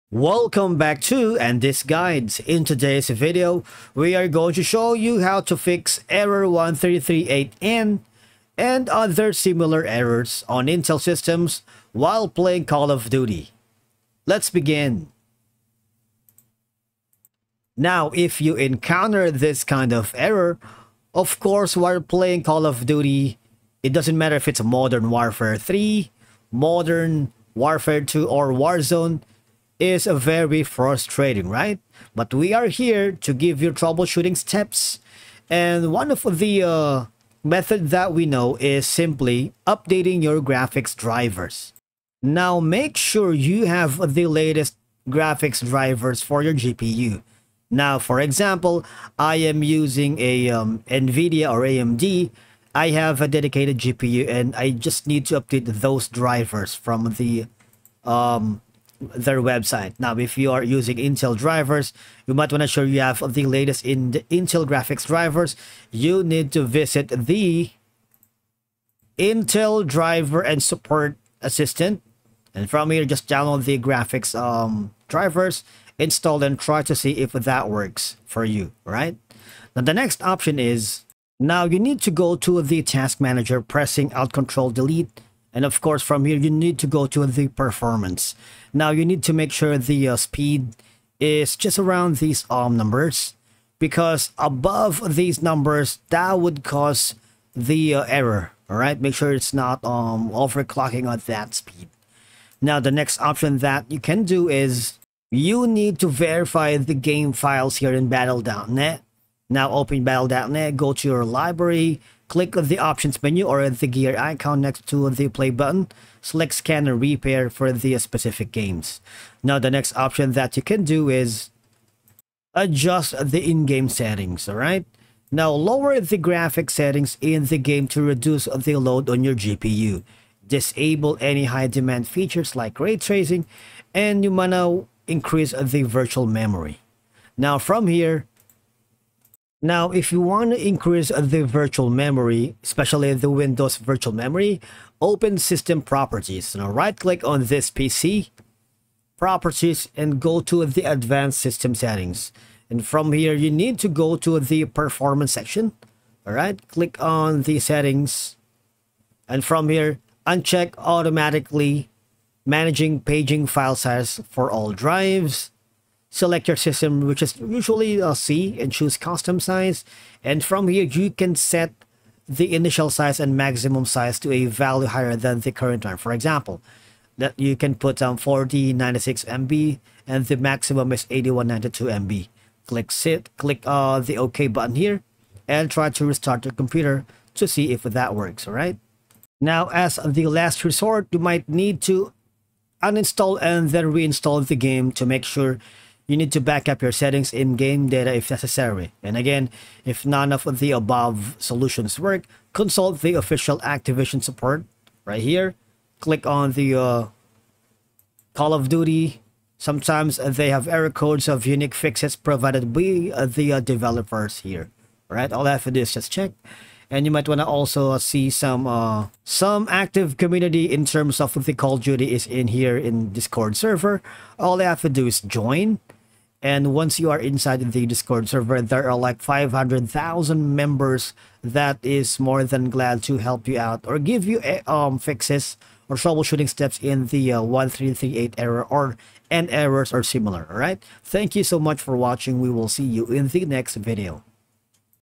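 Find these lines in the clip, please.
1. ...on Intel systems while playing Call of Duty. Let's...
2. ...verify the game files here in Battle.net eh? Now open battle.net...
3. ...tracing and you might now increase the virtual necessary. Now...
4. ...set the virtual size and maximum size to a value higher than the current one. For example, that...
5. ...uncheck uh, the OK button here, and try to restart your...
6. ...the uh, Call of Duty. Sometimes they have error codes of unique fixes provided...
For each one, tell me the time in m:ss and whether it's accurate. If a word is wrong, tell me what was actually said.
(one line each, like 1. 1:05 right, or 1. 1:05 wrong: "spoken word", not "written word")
1. 0:10 right
2. 1:46 right
3. 2:12 wrong: "memory", not "necessary"
4. 2:51 wrong: "initial", not "virtual"
5. 3:03 wrong: "click", not "uncheck"
6. 3:26 right.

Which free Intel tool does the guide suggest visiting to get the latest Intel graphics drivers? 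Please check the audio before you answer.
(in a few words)
Intel Driver and Support Assistant.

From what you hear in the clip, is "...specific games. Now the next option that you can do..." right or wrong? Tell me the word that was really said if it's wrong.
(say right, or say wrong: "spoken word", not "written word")
right.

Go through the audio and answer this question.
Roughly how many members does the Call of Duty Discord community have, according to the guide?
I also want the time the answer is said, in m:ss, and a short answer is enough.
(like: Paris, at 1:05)
500,000, at 3:49.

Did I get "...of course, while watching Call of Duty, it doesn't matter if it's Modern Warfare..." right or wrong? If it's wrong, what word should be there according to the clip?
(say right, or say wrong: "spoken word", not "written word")
wrong: "playing", not "watching".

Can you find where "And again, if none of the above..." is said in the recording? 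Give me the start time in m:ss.
3:19.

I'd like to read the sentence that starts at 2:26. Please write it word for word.
Now right click on this PC, properties and go to the advanced system settings.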